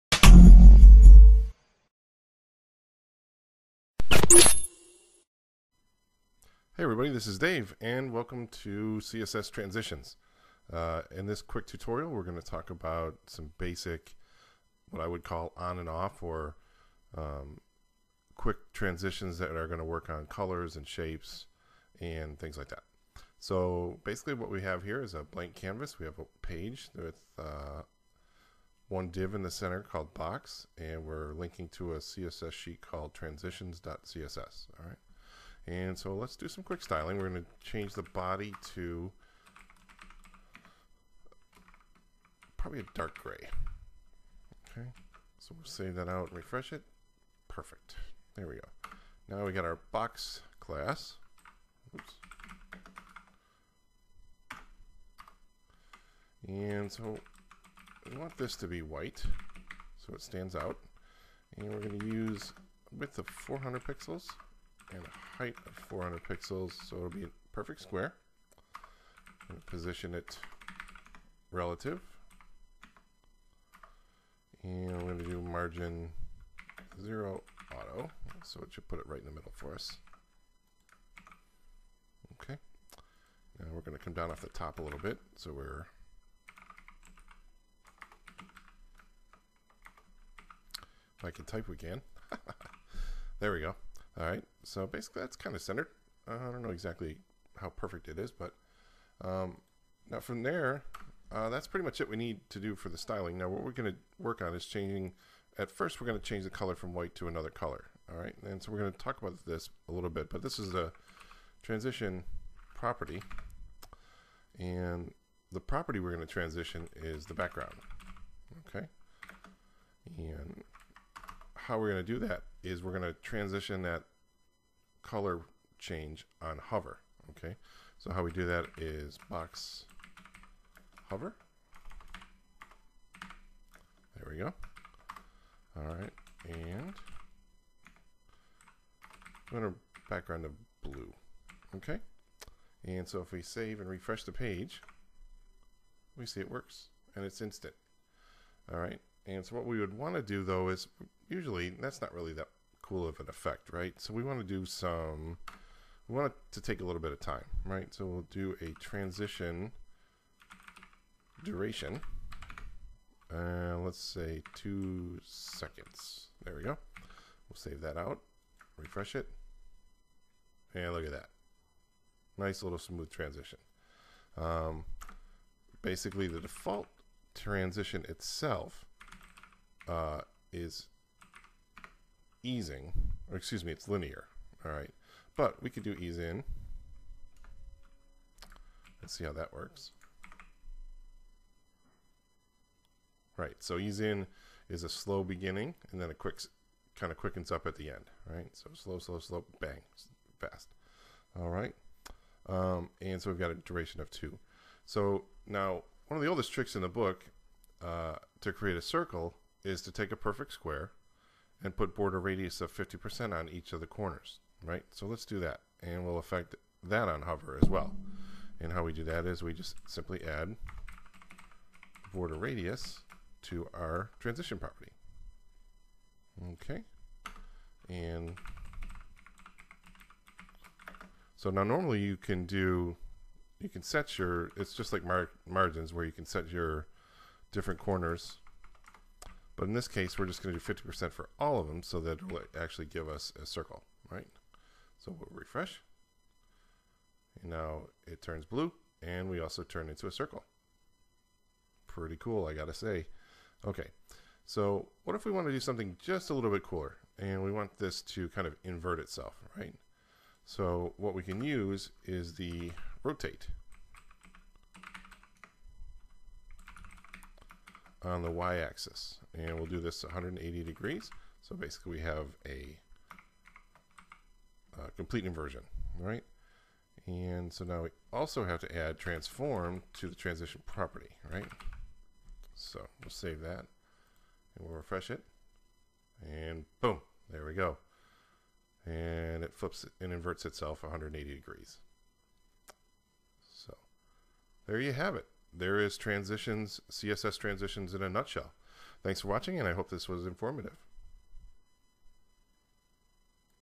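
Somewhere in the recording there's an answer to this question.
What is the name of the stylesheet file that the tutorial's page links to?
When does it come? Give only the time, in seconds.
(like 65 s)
33 s.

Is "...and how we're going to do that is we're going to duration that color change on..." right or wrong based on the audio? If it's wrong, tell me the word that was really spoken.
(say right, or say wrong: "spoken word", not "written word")
wrong: "transition", not "duration".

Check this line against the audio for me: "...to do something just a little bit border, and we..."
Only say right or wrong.
wrong.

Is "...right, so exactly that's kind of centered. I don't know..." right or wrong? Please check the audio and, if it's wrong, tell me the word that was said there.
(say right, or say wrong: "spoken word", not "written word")
wrong: "basically", not "exactly".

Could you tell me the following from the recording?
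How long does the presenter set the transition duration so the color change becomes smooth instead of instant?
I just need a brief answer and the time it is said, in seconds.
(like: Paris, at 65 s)
2 seconds, at 164 s.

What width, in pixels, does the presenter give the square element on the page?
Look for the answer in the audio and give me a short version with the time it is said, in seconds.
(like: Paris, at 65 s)
400 pixels, at 62 s.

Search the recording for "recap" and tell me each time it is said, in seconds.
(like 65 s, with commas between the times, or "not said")
not said.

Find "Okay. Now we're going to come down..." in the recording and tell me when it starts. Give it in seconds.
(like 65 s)
82 s.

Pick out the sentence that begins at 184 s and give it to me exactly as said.
All right, but we could do ease in.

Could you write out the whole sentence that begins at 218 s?
And how we do that is we just simply add border radius to our transition property.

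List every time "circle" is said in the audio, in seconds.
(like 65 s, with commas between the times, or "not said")
208 s, 243 s, 250 s.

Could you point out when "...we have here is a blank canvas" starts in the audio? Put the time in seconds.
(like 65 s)
24 s.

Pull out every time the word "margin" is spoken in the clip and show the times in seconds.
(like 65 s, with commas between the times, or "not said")
75 s, 235 s.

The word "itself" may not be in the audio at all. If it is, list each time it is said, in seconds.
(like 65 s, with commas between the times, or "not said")
178 s, 258 s, 290 s.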